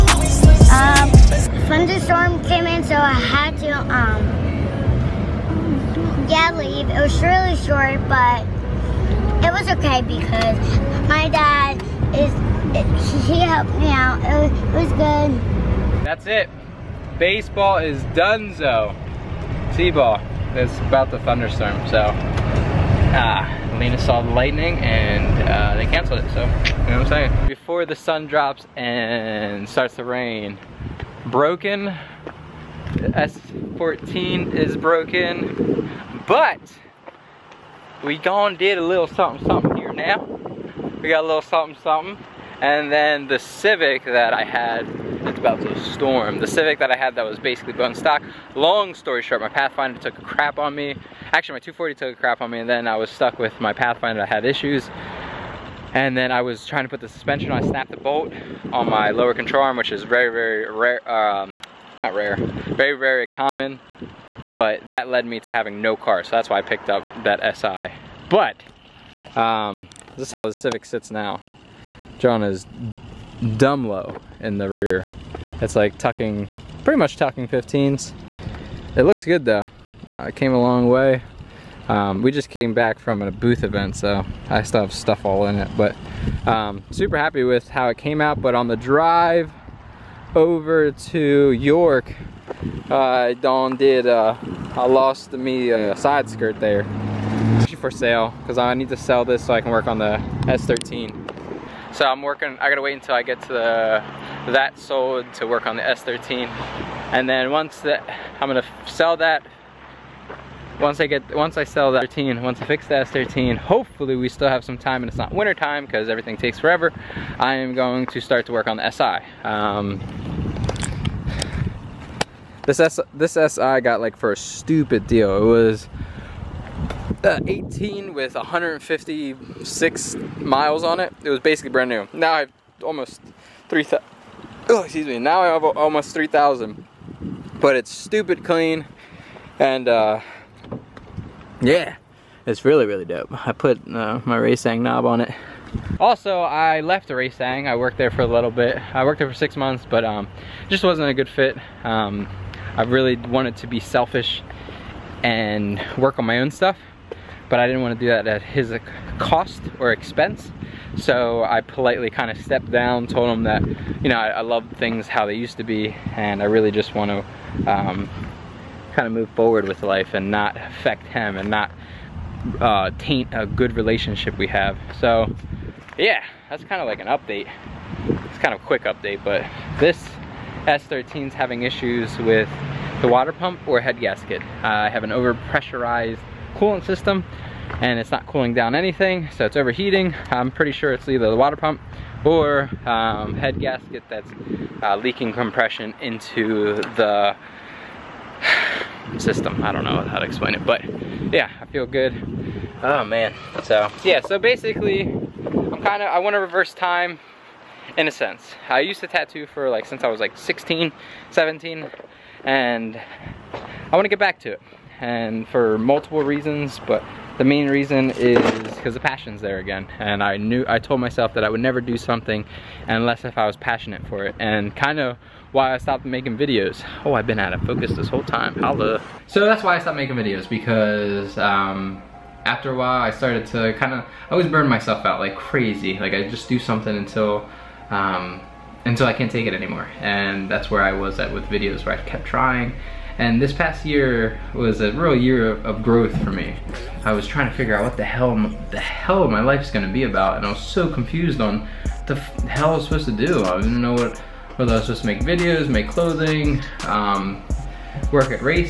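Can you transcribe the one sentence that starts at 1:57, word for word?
I am going to start to work on the SI.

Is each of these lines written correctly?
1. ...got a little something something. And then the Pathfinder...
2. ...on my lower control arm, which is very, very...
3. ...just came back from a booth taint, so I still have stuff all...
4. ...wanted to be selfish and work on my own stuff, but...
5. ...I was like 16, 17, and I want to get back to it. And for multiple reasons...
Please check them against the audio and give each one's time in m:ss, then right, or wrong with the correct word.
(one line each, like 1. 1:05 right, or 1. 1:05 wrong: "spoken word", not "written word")
1. 0:41 wrong: "Civic", not "Pathfinder"
2. 0:58 right
3. 1:22 wrong: "event", not "taint"
4. 2:33 right
5. 3:30 right.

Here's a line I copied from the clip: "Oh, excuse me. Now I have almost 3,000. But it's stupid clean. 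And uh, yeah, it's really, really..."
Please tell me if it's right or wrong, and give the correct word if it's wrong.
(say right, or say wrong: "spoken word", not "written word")
right.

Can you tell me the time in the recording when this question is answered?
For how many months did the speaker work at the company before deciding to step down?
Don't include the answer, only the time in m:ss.
2:29.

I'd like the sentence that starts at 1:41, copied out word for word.
So I'm working, I gotta wait until I get to the, that sold to work on the S13.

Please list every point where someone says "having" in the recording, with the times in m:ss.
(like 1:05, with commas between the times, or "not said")
1:05, 3:01.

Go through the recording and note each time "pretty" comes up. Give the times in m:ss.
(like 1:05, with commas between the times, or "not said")
1:16, 3:10.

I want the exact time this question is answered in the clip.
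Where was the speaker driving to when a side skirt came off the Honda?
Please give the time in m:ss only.
1:31.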